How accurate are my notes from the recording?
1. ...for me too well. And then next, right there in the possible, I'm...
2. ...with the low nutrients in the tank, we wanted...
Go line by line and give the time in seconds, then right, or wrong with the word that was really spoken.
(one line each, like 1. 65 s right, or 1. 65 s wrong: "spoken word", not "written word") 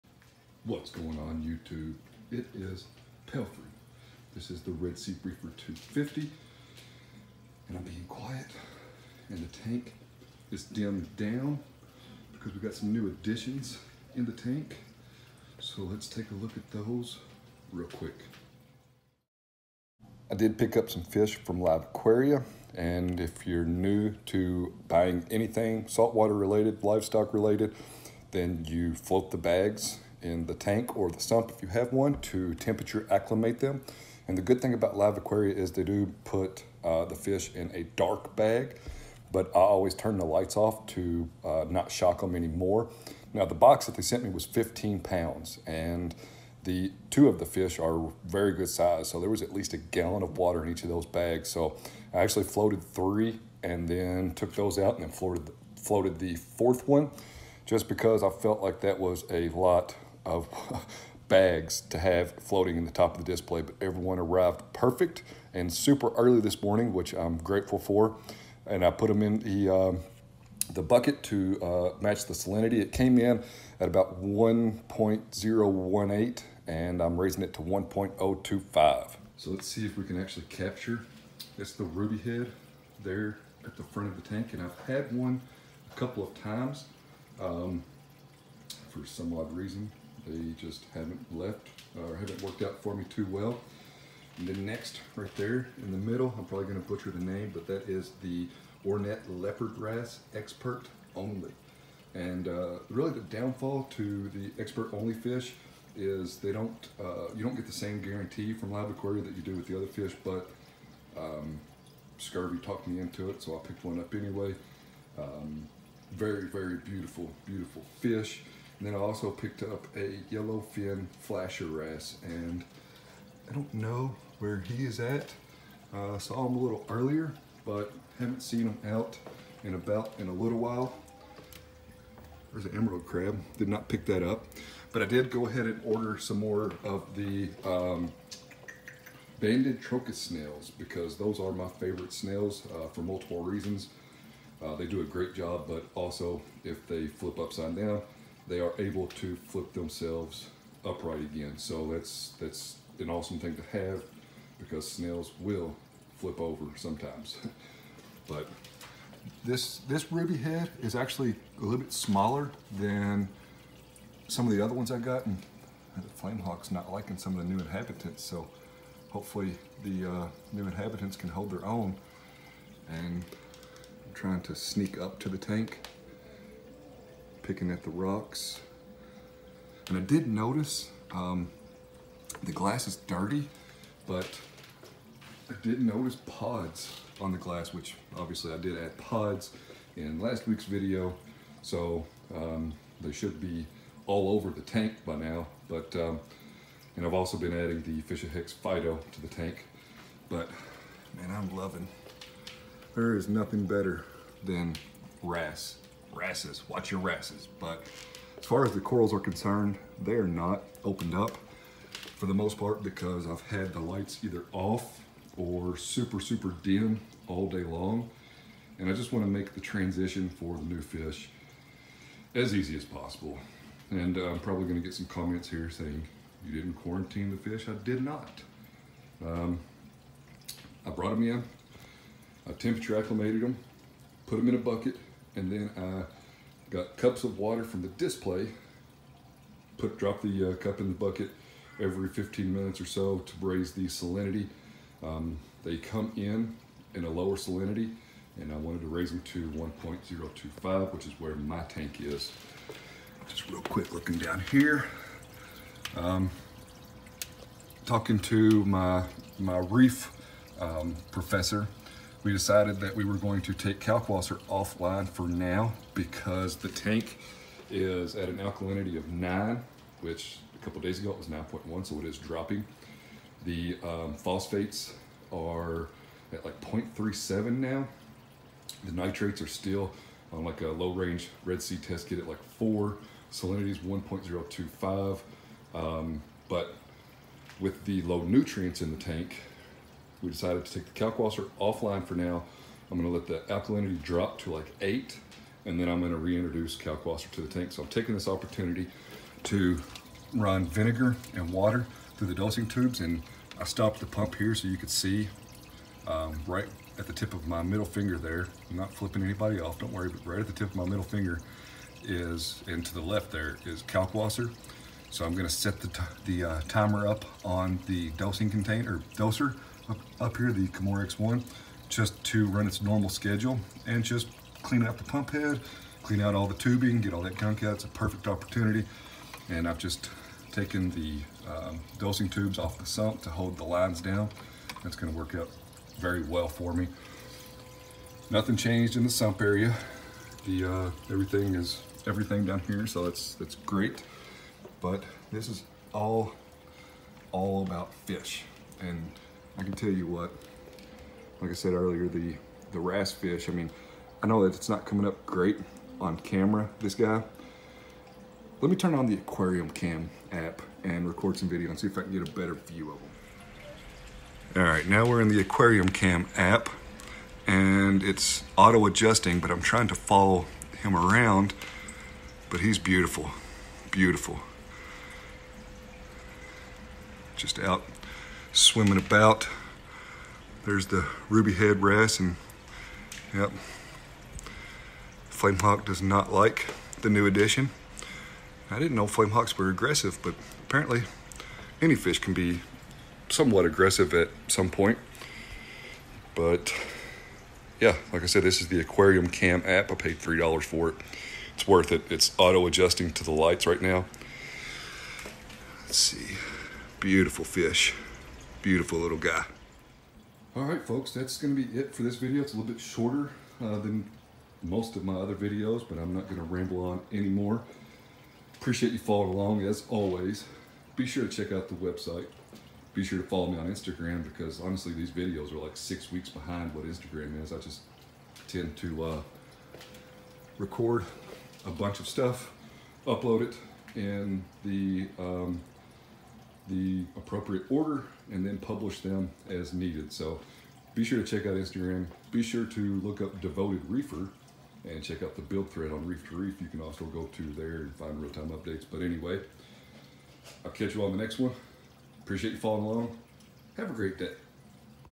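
1. 92 s wrong: "middle", not "possible"
2. 287 s wrong: "decided", not "wanted".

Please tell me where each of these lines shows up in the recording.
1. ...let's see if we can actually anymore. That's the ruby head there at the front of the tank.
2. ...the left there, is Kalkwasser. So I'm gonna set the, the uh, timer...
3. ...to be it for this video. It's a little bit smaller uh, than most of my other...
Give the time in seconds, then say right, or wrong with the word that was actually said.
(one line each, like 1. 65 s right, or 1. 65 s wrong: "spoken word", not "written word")
1. 79 s wrong: "capture", not "anymore"
2. 312 s right
3. 411 s wrong: "shorter", not "smaller".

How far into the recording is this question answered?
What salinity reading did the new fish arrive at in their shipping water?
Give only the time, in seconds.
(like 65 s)
74 s.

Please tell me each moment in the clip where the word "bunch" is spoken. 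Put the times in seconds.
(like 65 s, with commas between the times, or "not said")
431 s.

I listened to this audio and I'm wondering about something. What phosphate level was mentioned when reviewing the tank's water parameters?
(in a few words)
0.37.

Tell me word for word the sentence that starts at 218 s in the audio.
And I just wanna make the transition for the new fish as easy as possible.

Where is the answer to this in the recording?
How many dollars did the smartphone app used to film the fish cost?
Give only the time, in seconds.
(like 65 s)
400 s.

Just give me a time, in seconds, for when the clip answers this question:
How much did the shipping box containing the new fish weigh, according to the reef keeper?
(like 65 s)
44 s.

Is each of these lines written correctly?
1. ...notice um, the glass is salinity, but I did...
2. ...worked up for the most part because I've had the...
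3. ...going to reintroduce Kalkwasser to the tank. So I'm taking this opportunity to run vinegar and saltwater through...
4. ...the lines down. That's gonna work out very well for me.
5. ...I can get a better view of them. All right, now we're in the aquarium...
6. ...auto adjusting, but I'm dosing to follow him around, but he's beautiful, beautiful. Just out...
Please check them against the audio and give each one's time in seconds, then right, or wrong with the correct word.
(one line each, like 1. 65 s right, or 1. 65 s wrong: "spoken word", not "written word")
1. 180 s wrong: "dirty", not "salinity"
2. 210 s wrong: "opened", not "worked"
3. 295 s wrong: "water", not "saltwater"
4. 333 s right
5. 361 s right
6. 368 s wrong: "trying", not "dosing".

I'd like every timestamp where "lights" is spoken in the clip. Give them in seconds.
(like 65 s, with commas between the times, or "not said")
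40 s, 213 s, 403 s.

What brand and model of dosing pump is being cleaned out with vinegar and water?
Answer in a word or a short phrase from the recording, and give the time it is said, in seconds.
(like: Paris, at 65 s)
Kamoer X1, at 320 s.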